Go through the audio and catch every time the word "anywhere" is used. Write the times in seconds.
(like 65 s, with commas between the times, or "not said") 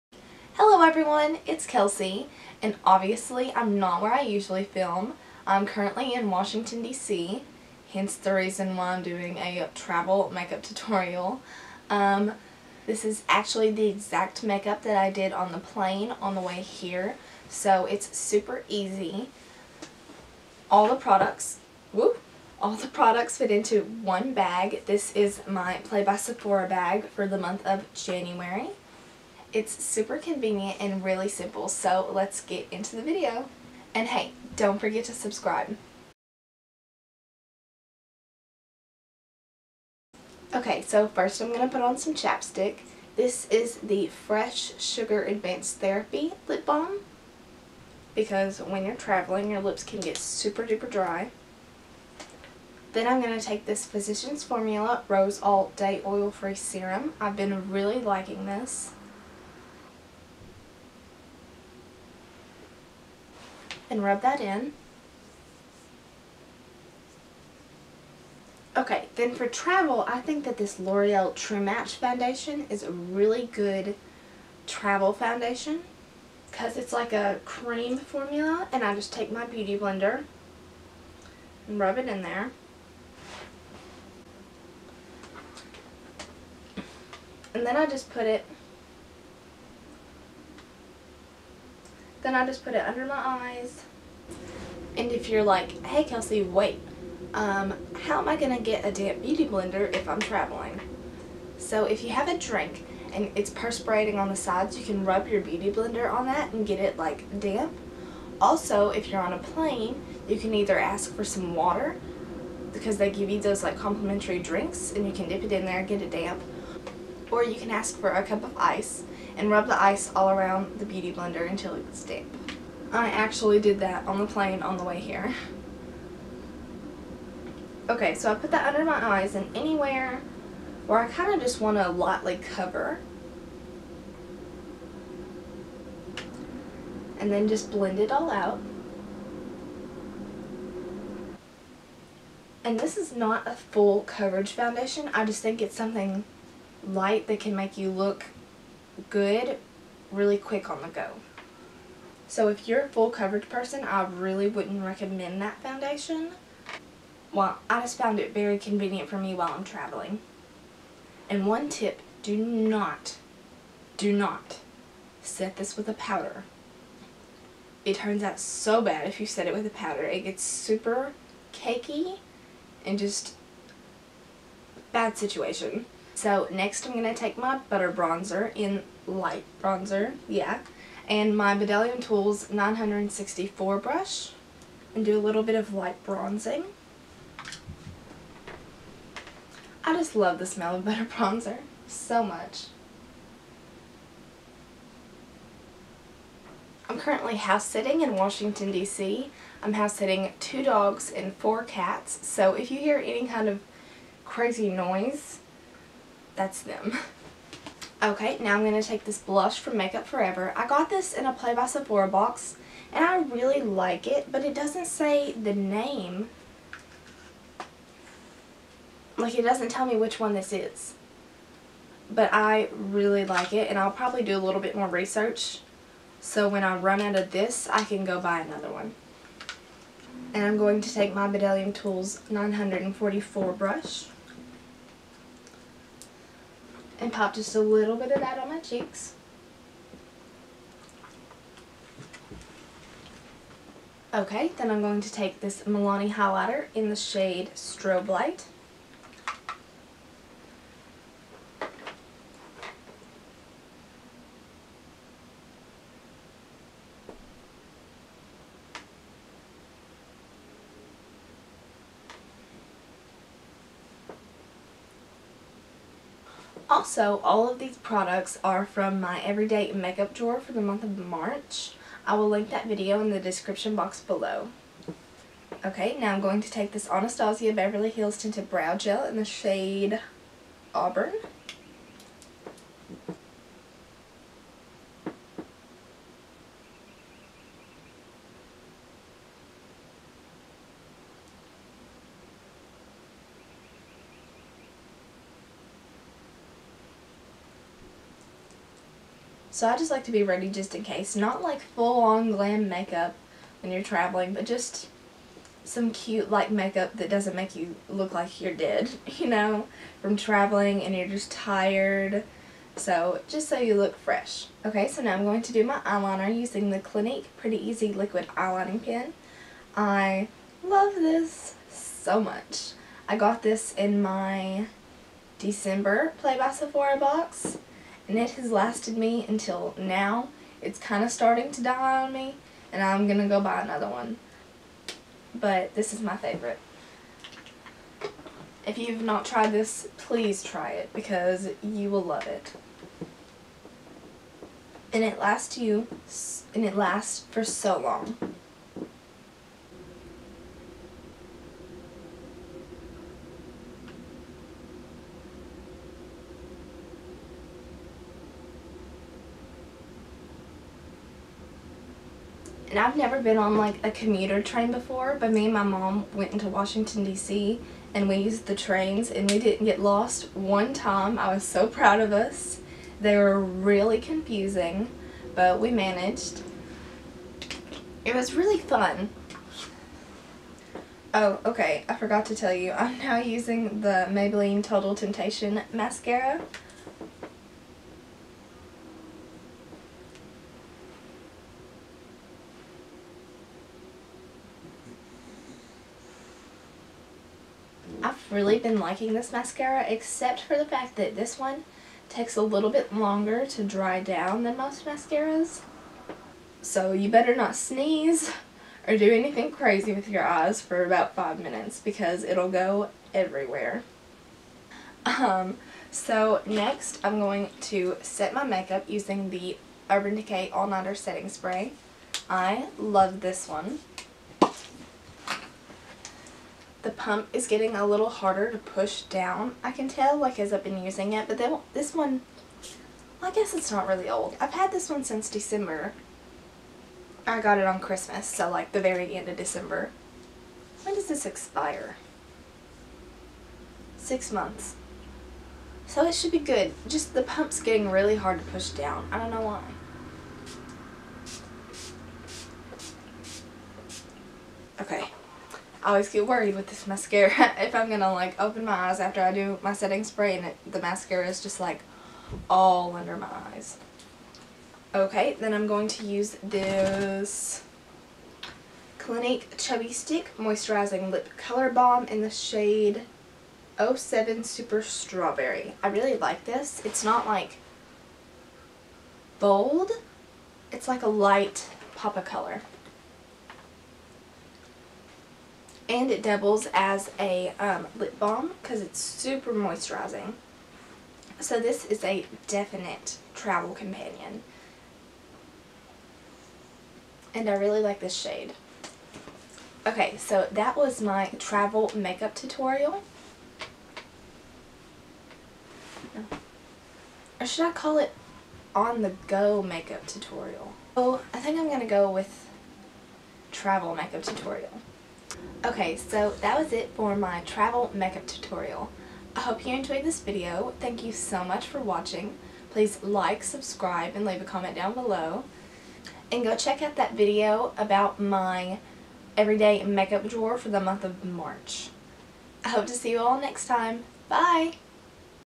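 129 s.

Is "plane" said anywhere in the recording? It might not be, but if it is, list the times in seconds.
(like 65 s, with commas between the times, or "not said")
15 s, 109 s, 124 s.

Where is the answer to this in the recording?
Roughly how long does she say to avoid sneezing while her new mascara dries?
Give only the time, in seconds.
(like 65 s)
411 s.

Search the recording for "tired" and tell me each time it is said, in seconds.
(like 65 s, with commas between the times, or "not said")
311 s.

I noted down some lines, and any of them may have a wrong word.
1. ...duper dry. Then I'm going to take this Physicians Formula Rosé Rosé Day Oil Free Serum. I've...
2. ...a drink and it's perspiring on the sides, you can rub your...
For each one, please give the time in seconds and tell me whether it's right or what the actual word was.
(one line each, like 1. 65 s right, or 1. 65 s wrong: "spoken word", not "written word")
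1. 50 s wrong: "All", not "Rosé"
2. 102 s right.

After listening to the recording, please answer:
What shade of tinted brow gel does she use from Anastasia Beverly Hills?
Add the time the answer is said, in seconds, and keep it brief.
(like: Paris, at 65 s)
Auburn, at 280 s.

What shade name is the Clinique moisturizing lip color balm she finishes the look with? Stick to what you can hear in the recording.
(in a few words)
Super Strawberry.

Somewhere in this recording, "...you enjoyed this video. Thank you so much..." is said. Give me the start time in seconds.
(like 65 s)
519 s.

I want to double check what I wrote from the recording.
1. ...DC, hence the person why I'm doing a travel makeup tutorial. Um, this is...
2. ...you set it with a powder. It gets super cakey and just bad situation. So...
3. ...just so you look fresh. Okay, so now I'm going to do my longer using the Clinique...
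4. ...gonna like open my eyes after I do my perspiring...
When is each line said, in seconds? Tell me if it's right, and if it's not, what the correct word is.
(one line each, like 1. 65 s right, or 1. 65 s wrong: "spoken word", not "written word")
1. 6 s wrong: "reason", not "person"
2. 169 s right
3. 313 s wrong: "eyeliner", not "longer"
4. 457 s wrong: "setting", not "perspiring".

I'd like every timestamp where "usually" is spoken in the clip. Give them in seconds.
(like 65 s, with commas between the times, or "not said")
4 s.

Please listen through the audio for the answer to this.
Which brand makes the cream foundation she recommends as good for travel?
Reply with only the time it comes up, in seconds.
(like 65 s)
70 s.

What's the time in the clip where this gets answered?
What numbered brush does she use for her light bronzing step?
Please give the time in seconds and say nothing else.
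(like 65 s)
182 s.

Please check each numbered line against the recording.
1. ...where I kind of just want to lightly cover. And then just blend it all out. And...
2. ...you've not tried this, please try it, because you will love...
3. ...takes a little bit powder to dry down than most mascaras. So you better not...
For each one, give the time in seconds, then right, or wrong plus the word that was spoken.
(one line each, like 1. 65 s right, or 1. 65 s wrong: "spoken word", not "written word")
1. 130 s right
2. 338 s right
3. 402 s wrong: "longer", not "powder".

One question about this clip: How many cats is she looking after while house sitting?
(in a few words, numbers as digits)
4.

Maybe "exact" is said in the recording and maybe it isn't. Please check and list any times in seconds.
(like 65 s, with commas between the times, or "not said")
13 s.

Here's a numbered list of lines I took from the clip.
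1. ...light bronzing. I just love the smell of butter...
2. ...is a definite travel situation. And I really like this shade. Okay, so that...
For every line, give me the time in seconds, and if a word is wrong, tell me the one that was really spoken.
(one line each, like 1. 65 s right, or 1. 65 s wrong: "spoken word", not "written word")
1. 185 s right
2. 491 s wrong: "companion", not "situation".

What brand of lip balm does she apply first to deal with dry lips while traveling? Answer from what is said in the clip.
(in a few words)
Fresh Sugar Advanced Therapy.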